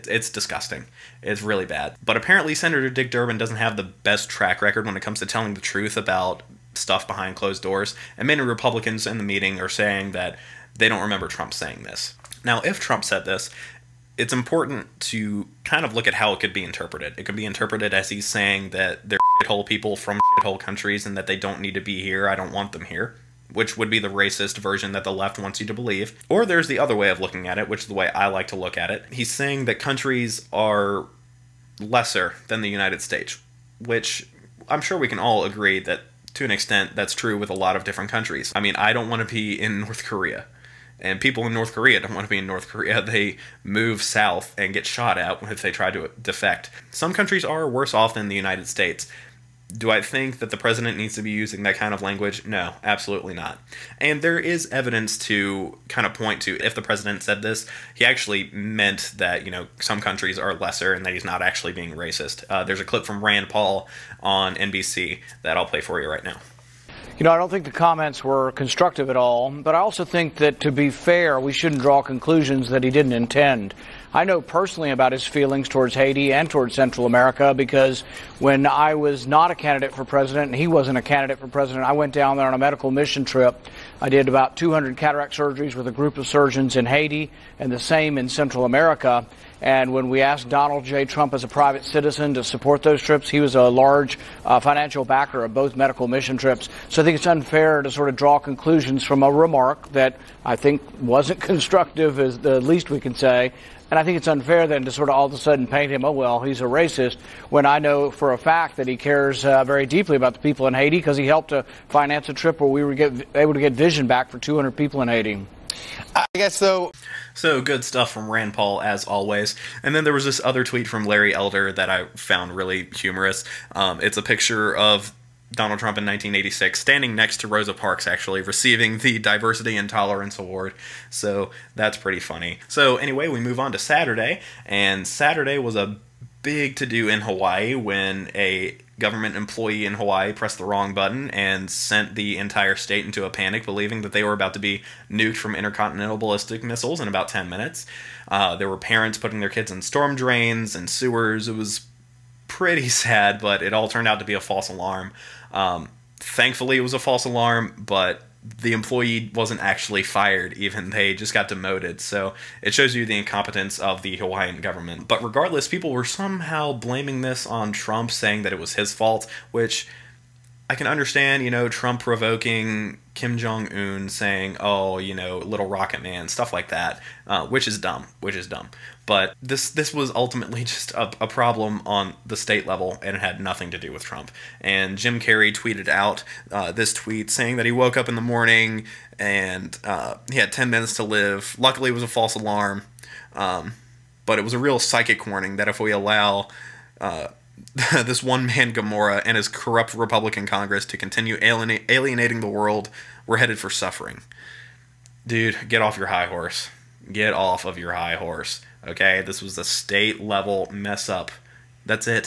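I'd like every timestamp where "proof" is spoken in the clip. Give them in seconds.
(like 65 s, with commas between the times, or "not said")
not said.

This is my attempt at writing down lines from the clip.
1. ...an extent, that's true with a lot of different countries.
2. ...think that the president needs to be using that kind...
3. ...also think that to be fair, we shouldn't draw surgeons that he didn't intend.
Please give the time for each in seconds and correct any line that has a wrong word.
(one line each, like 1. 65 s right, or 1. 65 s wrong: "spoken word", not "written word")
1. 36 s right
2. 50 s right
3. 69 s wrong: "conclusions", not "surgeons".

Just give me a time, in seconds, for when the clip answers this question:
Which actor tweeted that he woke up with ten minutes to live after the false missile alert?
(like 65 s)
184 s.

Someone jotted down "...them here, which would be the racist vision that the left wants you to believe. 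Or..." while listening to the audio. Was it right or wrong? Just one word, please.
wrong.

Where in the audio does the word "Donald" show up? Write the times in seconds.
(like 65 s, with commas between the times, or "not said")
90 s, 125 s.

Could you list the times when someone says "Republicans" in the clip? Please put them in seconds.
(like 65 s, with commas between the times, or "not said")
8 s, 199 s.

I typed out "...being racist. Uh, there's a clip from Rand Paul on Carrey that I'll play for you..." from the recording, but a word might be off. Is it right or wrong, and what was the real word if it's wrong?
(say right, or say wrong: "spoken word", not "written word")
wrong: "NBC", not "Carrey".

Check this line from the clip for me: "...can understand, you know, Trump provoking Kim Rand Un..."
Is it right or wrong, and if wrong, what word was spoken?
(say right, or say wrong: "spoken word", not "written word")
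wrong: "Jong", not "Rand".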